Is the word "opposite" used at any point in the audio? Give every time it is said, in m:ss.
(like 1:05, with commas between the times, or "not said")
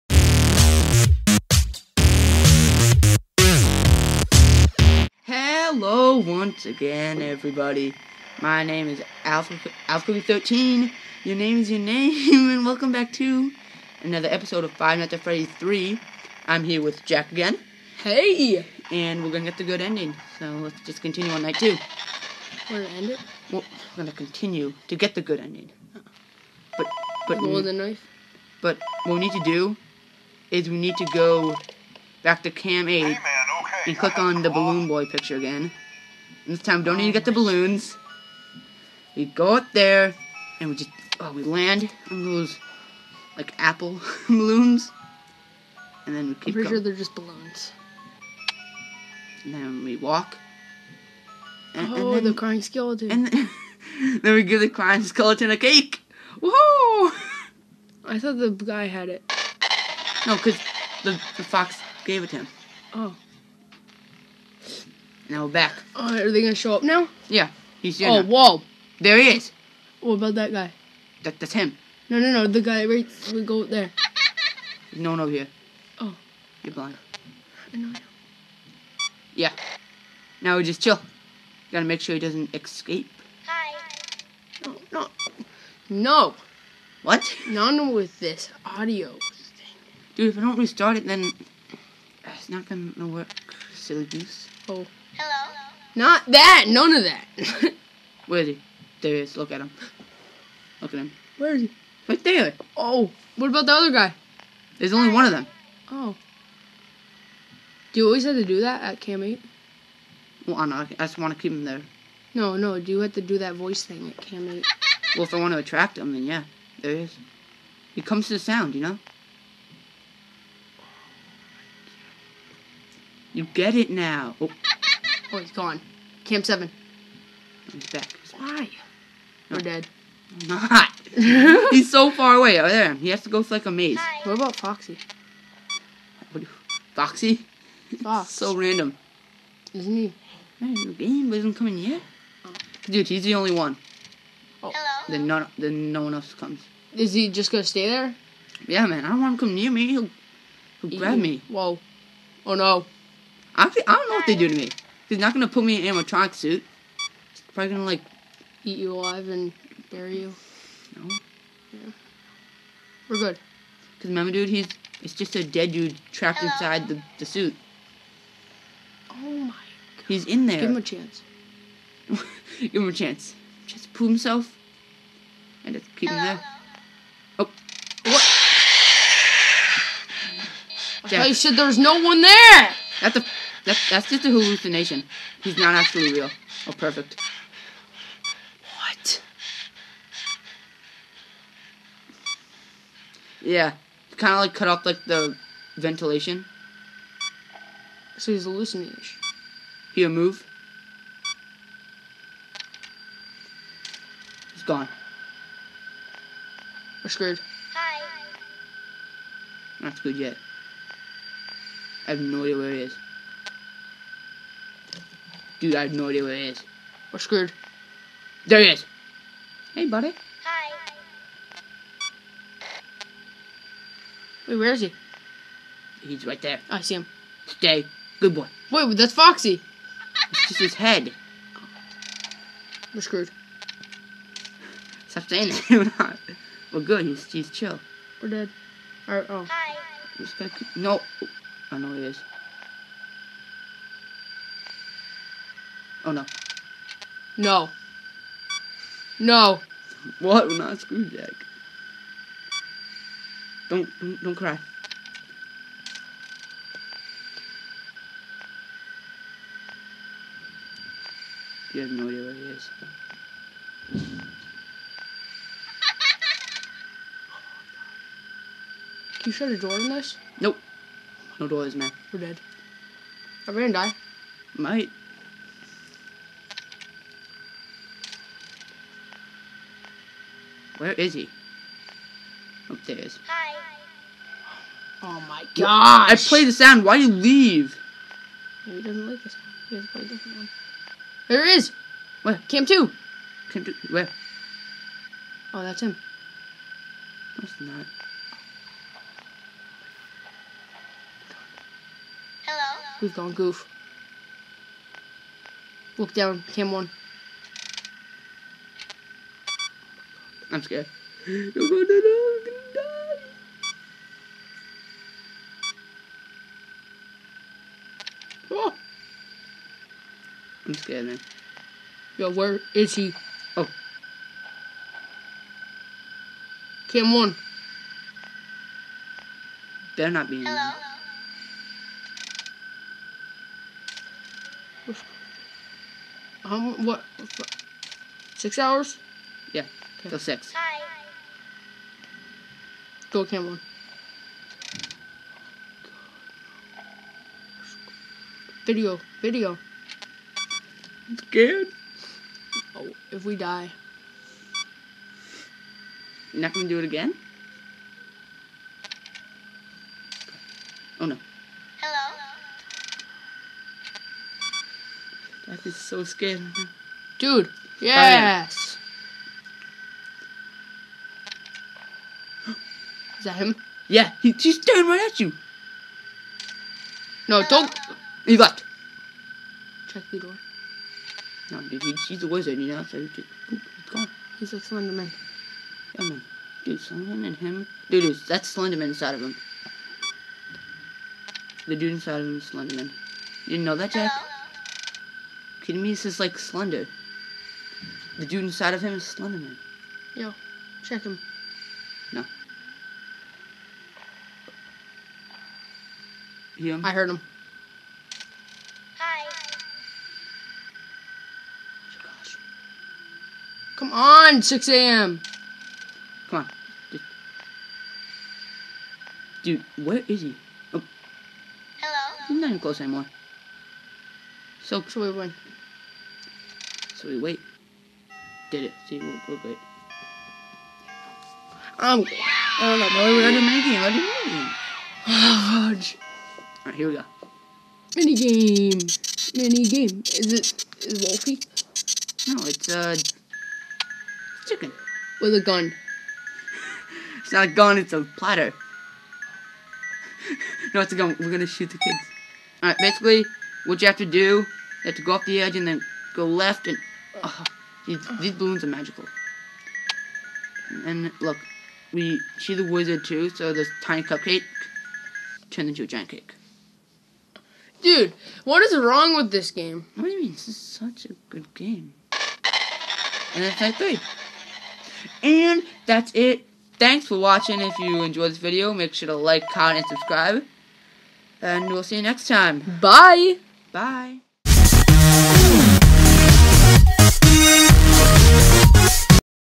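not said.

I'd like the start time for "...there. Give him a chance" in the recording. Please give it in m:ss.
2:50.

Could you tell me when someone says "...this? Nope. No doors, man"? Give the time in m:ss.
4:29.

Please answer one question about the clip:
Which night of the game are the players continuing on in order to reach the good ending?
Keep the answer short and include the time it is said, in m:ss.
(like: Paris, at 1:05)
Night two, at 0:21.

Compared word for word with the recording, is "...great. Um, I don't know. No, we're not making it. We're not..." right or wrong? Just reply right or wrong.
right.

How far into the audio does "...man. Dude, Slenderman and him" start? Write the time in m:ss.
6:26.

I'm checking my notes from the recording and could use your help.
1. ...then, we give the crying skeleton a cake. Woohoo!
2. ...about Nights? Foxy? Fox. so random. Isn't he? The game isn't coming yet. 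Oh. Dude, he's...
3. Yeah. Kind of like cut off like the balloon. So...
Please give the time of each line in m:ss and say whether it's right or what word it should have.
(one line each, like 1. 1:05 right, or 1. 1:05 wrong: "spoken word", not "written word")
1. 0:54 right
2. 2:14 wrong: "Foxy", not "Nights"
3. 3:13 wrong: "ventilation", not "balloon".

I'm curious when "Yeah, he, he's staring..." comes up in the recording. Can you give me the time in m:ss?
6:13.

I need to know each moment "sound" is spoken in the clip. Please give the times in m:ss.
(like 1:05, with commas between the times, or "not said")
1:58, 4:46.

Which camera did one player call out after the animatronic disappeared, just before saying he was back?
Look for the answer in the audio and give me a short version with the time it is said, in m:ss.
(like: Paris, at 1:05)
Cam 7, at 2:06.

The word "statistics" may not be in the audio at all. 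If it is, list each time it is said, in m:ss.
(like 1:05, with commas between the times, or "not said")
not said.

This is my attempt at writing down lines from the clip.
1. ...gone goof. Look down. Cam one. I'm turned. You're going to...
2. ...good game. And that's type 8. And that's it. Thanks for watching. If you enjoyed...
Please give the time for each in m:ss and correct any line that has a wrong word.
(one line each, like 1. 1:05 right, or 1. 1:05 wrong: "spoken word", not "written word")
1. 5:03 wrong: "scared", not "turned"
2. 7:51 wrong: "3", not "8".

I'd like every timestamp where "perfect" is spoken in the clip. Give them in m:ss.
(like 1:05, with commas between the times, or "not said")
3:06.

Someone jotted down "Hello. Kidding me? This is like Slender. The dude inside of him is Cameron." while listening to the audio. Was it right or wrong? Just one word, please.
wrong.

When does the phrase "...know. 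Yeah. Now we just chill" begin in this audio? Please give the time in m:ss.
1:17.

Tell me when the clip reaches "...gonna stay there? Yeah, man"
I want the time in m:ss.
2:27.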